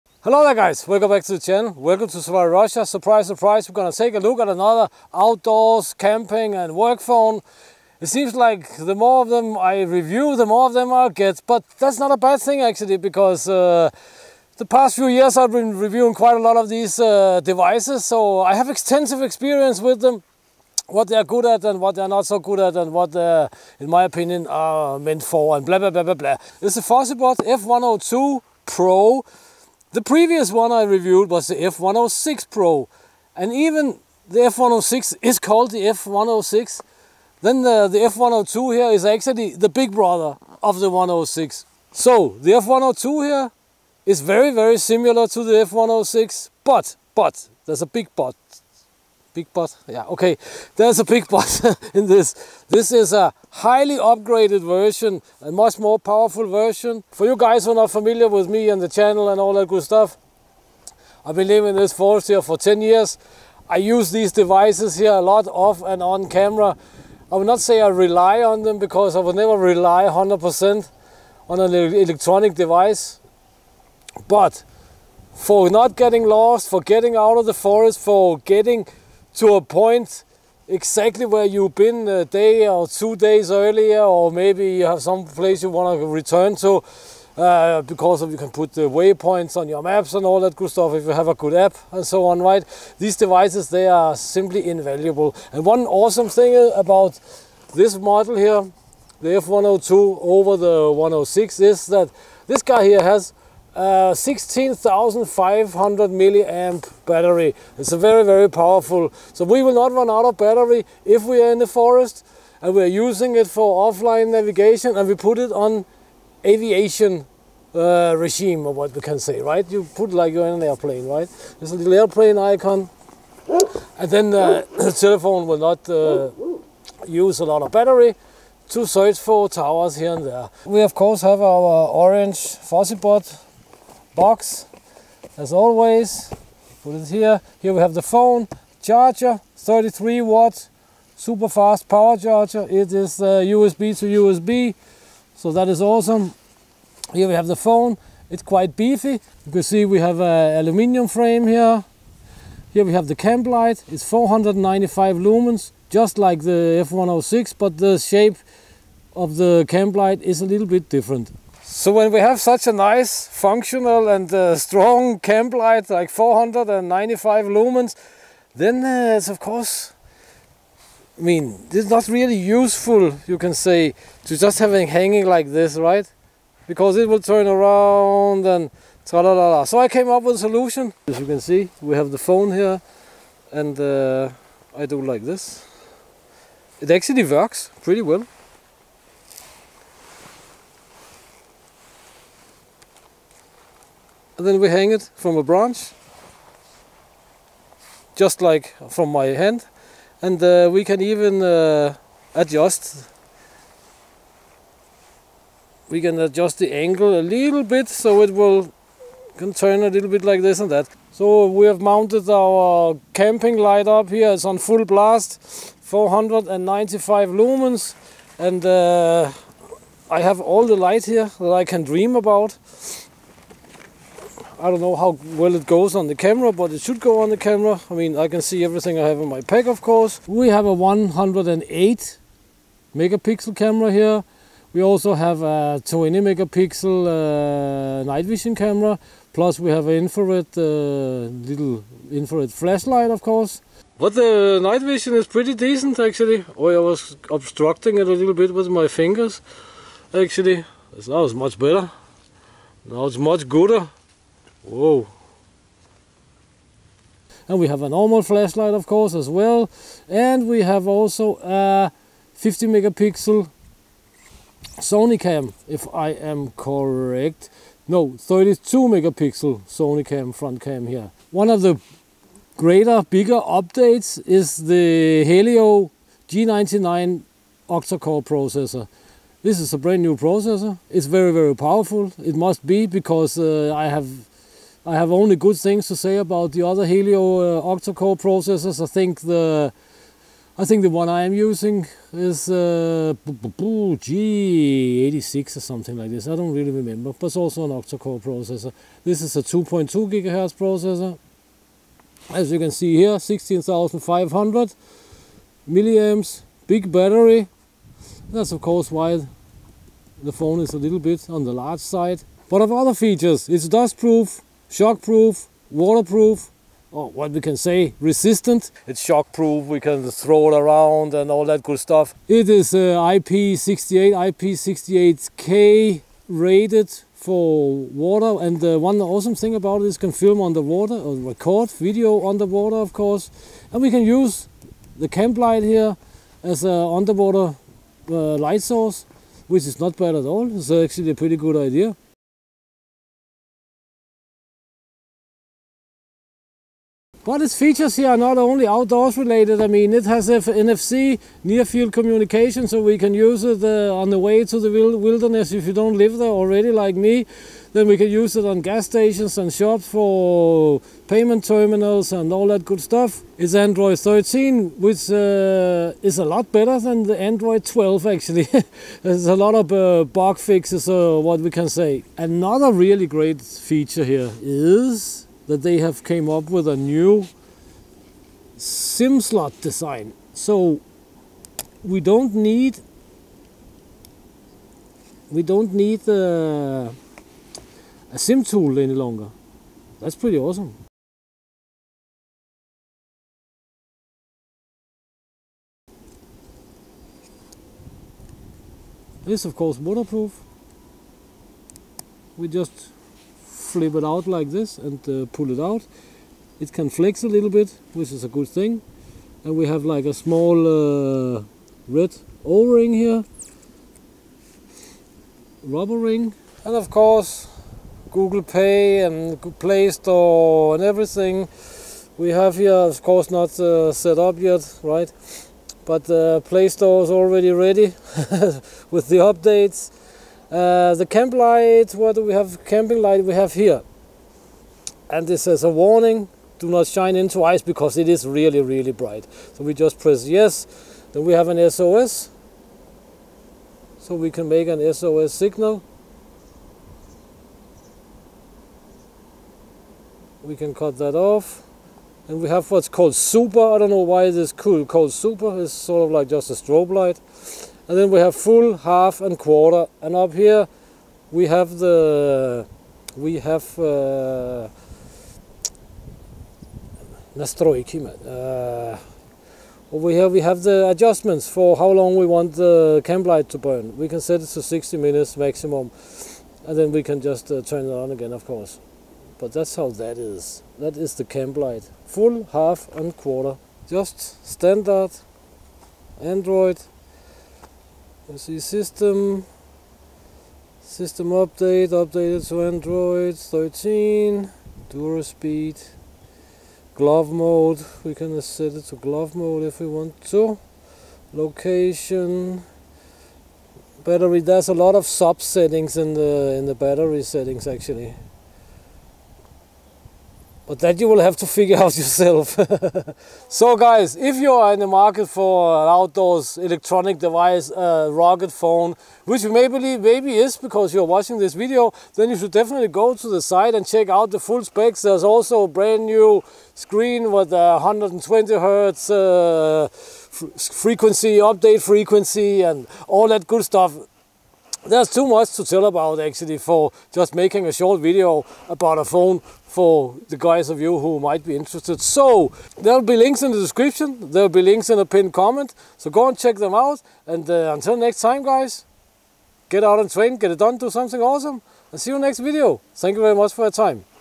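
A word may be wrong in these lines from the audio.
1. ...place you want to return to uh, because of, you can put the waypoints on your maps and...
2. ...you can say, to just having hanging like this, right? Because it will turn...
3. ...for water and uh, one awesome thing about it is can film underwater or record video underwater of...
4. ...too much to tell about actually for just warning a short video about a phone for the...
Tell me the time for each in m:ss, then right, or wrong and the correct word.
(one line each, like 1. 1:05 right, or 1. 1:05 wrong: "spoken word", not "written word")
1. 1:25 right
2. 2:53 right
3. 5:27 right
4. 8:55 wrong: "making", not "warning".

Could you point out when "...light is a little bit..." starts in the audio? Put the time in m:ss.
2:39.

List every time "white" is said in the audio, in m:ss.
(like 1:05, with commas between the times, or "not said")
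not said.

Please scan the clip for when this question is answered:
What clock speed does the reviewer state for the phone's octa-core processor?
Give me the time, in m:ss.
4:59.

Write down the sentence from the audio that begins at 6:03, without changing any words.
It's Android 13, which uh, is a lot better than the Android 12 actually.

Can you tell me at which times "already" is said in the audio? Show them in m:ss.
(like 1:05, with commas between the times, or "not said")
5:56, 7:07.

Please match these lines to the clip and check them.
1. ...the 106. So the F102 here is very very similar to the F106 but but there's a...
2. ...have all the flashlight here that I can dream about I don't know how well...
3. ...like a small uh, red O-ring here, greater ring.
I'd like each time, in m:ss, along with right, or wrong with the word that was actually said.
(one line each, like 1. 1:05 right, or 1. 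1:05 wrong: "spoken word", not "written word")
1. 0:40 right
2. 3:40 wrong: "light", not "flashlight"
3. 6:49 wrong: "rubber", not "greater".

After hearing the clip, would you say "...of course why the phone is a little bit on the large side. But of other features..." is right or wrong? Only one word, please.
right.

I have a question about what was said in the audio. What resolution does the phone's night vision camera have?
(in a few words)
20 megapixel.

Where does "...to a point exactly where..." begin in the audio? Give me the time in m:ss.
1:19.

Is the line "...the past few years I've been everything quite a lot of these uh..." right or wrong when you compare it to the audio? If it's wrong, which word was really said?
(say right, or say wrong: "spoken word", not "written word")
wrong: "reviewing", not "everything".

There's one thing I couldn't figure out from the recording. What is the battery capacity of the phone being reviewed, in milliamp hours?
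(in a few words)
16,500.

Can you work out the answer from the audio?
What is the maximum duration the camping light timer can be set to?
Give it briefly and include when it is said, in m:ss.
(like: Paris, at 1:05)
60 minutes, at 7:54.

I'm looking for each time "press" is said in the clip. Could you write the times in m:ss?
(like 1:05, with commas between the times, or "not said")
7:19.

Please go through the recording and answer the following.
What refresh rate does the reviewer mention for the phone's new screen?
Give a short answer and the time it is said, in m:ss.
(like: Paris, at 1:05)
120 hertz, at 8:47.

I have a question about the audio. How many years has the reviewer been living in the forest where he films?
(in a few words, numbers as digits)
10 years.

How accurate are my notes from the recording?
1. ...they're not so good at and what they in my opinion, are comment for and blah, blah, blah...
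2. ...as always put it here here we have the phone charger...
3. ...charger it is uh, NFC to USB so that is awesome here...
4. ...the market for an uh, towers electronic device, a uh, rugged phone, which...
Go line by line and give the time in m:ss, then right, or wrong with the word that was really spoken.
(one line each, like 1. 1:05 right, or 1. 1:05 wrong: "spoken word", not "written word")
1. 0:21 wrong: "meant", not "comment"
2. 2:15 right
3. 2:22 wrong: "USB", not "NFC"
4. 8:34 wrong: "outdoors", not "towers".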